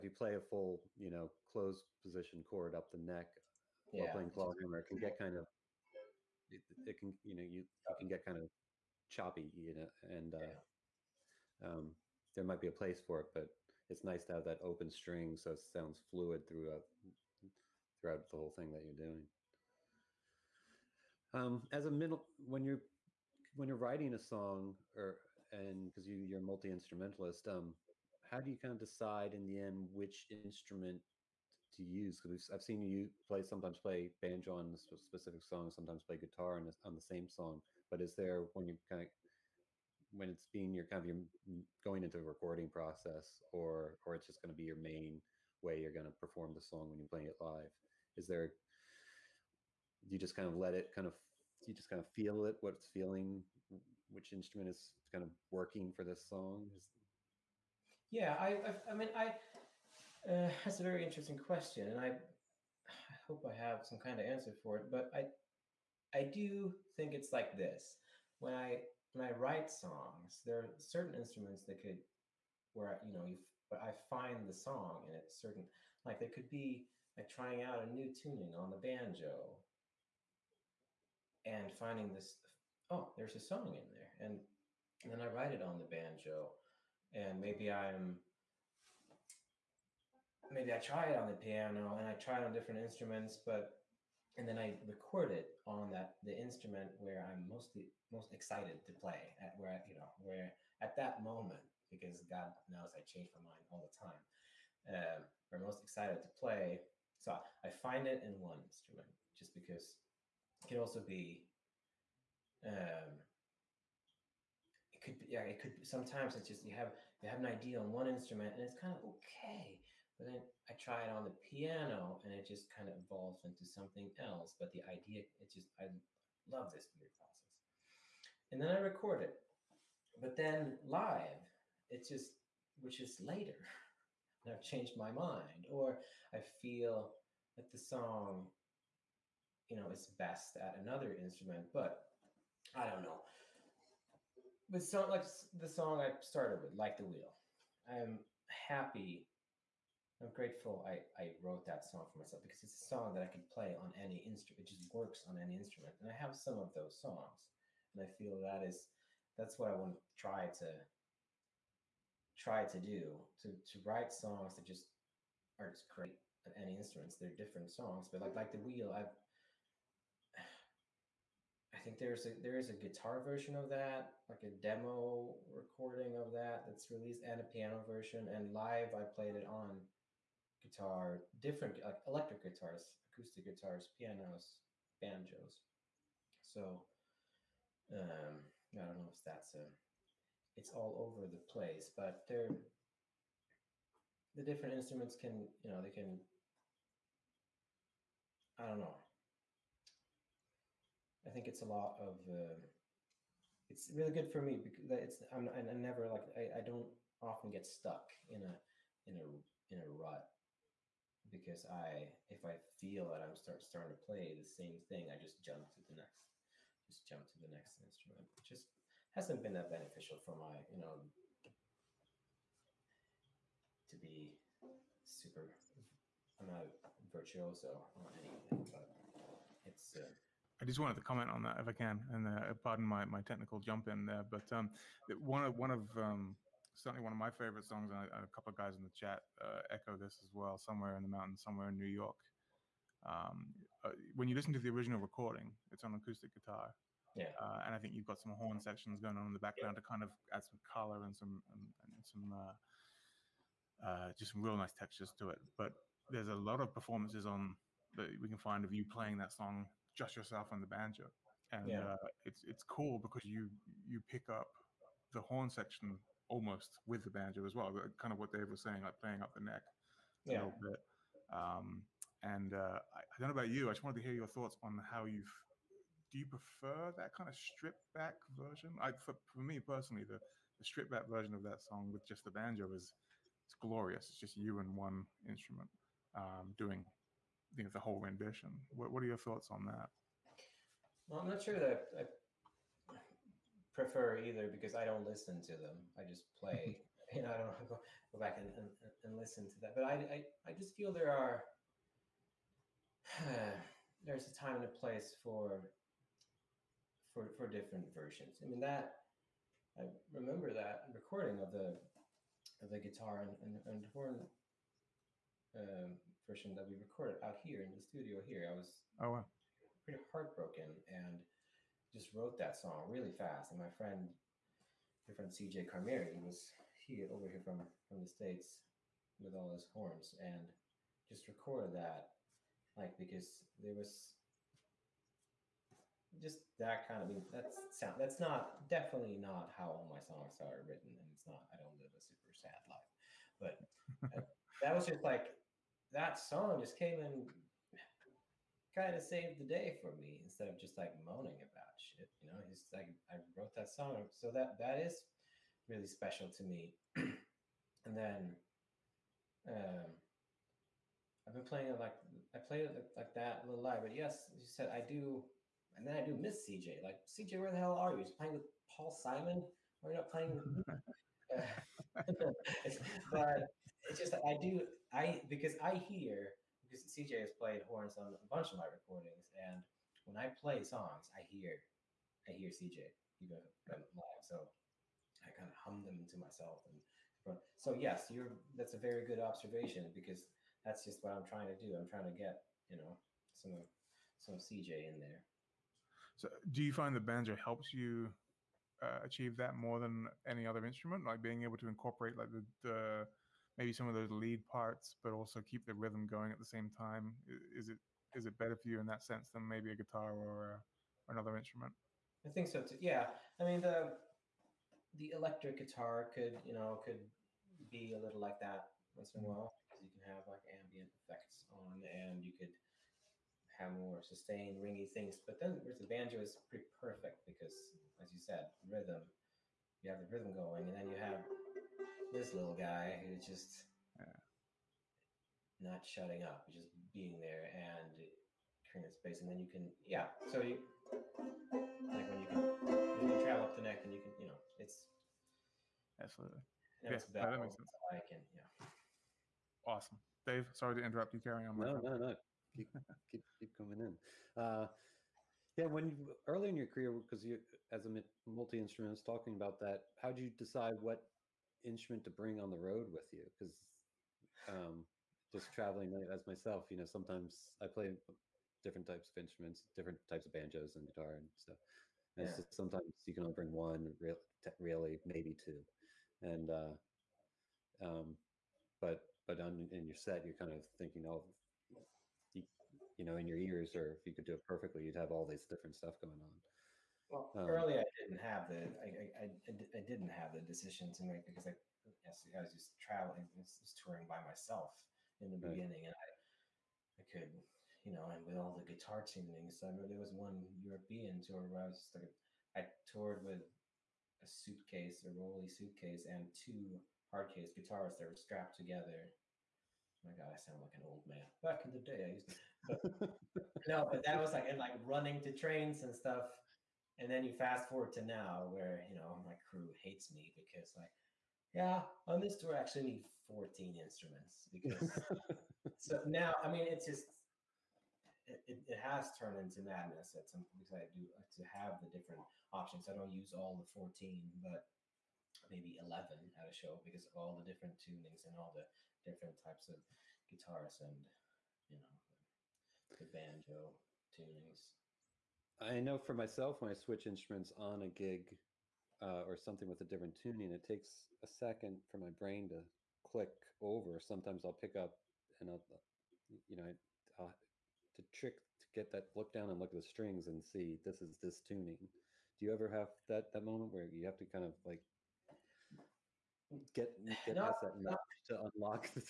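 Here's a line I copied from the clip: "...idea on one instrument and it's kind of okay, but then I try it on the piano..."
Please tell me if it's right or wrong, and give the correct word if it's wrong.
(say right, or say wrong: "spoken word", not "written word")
right.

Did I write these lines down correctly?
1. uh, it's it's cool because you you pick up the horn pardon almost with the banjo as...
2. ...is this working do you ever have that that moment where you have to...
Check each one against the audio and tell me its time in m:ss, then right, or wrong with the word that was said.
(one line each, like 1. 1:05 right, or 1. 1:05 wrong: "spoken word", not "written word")
1. 4:21 wrong: "section", not "pardon"
2. 9:21 wrong: "tuning", not "working".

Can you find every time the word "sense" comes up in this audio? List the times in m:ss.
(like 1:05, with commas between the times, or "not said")
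6:49, 7:27.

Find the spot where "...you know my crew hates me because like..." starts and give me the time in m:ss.
8:38.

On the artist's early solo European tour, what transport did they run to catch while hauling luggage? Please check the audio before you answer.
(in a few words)
trains.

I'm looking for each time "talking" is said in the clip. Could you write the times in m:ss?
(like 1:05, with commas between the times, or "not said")
7:39.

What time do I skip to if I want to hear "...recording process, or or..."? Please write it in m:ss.
0:42.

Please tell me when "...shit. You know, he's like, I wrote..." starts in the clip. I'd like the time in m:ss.
5:51.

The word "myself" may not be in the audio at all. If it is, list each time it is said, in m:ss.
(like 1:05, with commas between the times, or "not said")
2:32, 6:26, 7:46, 8:14, 9:06.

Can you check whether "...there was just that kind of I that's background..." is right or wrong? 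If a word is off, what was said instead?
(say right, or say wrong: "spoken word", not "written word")
wrong: "sound", not "background".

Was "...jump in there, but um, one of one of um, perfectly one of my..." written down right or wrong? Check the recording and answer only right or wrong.
wrong.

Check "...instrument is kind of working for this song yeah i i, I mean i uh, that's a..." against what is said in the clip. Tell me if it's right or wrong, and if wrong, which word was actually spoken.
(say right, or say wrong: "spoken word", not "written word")
right.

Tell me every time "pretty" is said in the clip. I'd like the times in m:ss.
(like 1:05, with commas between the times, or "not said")
5:19, 7:06.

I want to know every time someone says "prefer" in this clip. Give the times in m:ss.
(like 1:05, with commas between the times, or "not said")
4:36, 4:53.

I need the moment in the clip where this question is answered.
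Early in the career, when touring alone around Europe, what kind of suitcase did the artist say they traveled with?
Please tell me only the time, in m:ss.
8:25.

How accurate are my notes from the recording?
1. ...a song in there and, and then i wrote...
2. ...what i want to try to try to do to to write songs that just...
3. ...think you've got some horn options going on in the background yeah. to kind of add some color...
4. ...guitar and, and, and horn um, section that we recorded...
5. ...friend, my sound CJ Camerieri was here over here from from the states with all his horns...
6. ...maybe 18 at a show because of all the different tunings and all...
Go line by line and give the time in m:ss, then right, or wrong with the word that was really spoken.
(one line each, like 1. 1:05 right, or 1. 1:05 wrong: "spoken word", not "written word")
1. 1:23 wrong: "write", not "wrote"
2. 2:39 right
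3. 4:07 wrong: "sections", not "options"
4. 5:12 wrong: "version", not "section"
5. 5:23 wrong: "friend", not "sound"
6. 8:55 wrong: "11", not "18".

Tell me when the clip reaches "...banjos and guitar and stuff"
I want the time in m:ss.
7:50.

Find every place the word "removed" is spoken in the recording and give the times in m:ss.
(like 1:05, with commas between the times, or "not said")
not said.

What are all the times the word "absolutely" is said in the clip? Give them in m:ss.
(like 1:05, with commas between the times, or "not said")
7:25.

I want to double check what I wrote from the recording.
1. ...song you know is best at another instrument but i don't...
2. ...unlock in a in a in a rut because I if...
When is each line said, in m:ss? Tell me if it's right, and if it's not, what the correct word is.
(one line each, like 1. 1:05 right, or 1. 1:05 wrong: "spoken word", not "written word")
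1. 2:17 right
2. 3:27 wrong: "stuck", not "unlock".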